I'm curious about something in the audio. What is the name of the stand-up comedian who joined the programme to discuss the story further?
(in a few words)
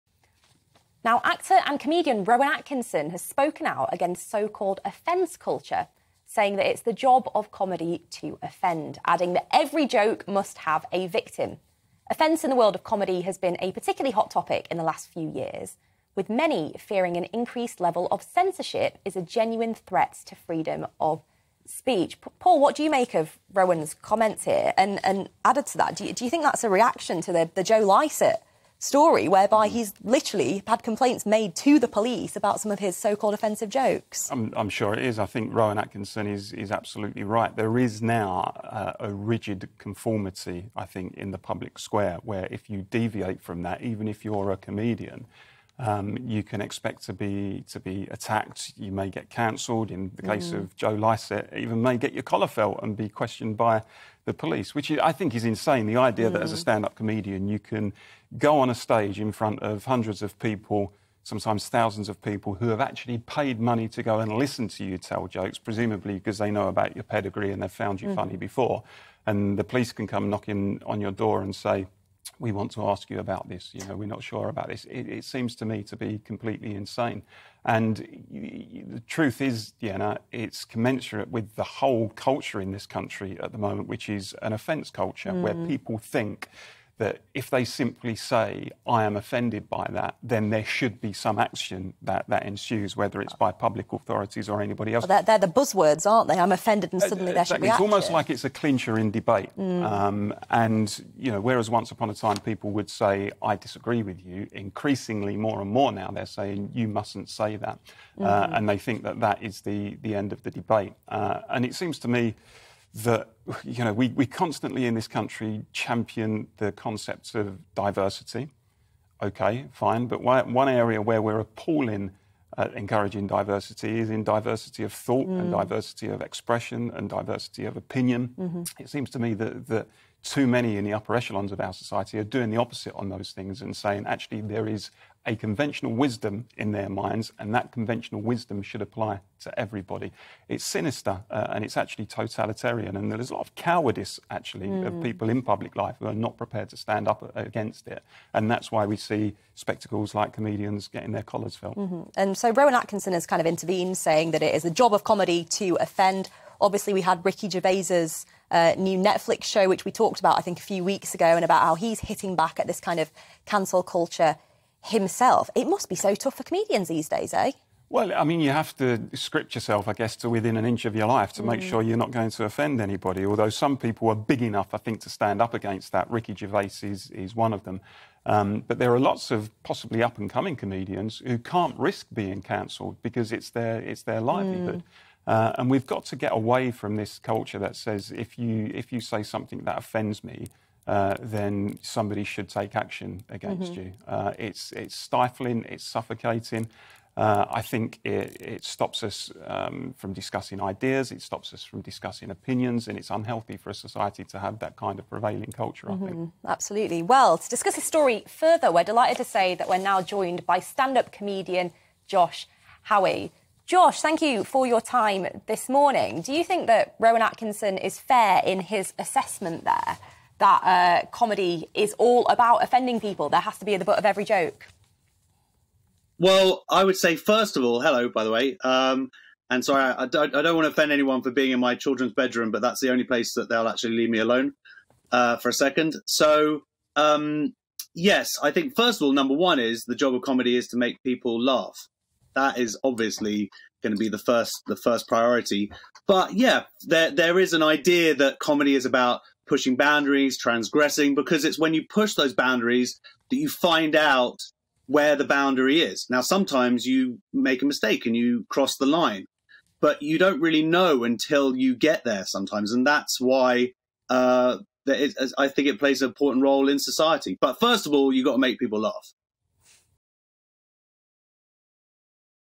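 Josh Howie.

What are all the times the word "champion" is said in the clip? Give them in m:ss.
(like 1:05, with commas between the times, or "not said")
1:55.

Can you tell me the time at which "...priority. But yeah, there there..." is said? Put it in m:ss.
4:05.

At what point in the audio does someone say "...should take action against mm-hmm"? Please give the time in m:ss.
3:12.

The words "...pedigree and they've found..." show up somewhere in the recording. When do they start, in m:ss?
1:07.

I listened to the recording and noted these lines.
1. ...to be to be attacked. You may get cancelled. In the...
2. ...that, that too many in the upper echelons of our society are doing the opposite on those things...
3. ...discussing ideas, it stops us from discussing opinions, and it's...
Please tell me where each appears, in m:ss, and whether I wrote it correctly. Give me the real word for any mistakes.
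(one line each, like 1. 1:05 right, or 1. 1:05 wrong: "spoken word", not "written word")
1. 0:47 right
2. 2:09 right
3. 3:20 right.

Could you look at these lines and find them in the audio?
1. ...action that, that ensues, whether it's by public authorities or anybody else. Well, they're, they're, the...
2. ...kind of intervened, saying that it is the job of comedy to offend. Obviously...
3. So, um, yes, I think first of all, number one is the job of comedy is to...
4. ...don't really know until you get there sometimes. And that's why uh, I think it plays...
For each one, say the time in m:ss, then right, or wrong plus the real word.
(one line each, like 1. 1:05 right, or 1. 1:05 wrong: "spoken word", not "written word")
1. 1:31 right
2. 2:33 right
3. 3:56 right
4. 4:20 right.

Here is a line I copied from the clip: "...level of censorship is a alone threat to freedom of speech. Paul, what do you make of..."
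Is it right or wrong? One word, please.
wrong.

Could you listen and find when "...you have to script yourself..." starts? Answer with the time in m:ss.
2:48.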